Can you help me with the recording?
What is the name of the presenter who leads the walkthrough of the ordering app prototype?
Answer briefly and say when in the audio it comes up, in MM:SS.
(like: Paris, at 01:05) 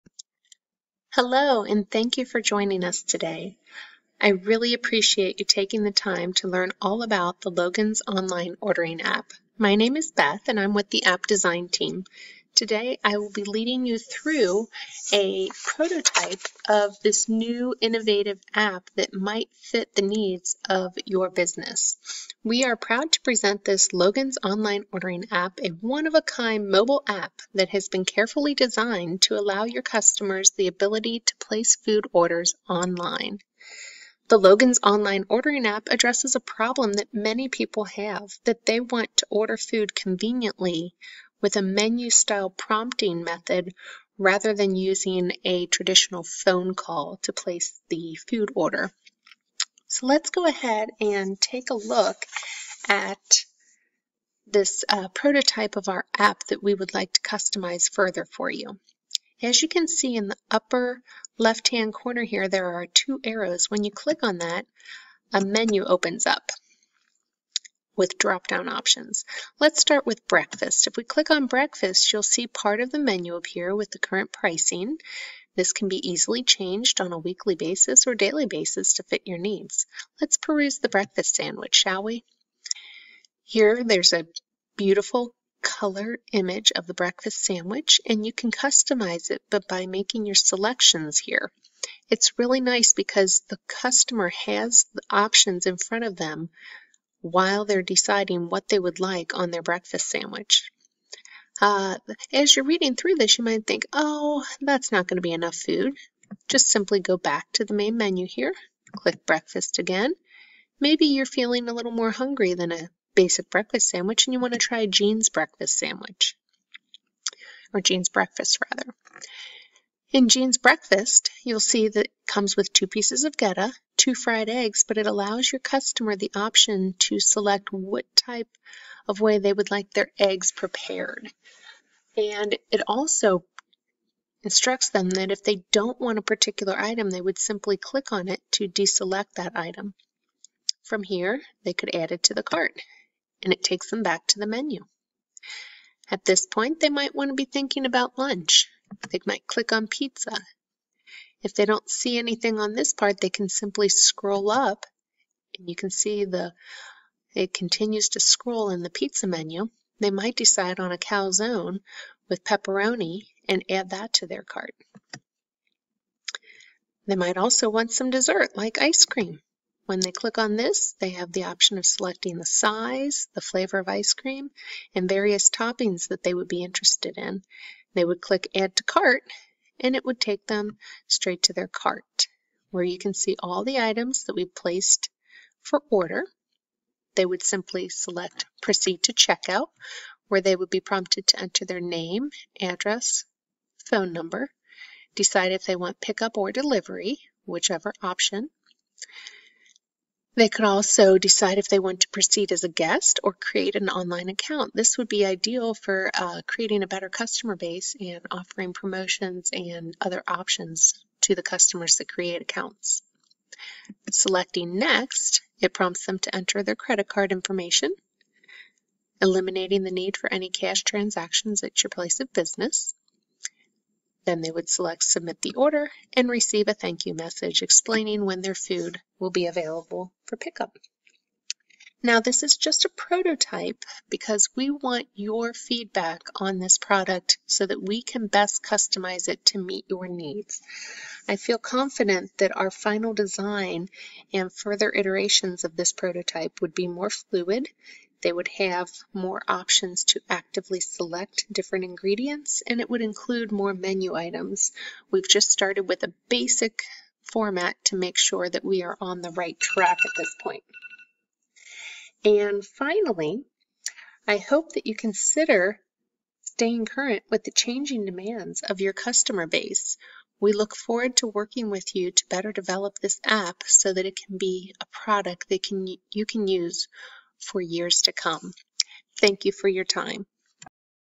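Beth, at 00:10.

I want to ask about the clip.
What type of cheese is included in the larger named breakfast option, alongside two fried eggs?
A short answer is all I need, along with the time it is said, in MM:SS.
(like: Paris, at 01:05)
Gouda, at 02:03.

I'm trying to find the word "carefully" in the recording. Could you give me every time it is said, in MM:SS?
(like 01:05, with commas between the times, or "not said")
00:28.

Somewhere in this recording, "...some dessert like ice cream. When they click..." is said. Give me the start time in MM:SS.
02:47.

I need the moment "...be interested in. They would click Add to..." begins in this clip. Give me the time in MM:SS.
02:56.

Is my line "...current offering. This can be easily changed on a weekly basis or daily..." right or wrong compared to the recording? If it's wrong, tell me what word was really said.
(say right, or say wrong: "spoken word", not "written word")
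wrong: "pricing", not "offering".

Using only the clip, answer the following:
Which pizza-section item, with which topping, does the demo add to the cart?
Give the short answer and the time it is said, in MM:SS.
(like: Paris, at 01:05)
Calzone with pepperoni, at 02:40.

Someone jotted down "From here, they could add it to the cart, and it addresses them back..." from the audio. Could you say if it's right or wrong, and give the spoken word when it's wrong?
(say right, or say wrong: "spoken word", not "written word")
wrong: "takes", not "addresses".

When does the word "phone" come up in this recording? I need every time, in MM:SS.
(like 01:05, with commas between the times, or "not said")
00:46, 03:13.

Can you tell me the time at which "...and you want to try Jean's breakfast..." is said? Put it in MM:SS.
01:54.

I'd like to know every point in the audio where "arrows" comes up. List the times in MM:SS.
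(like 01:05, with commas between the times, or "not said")
01:03.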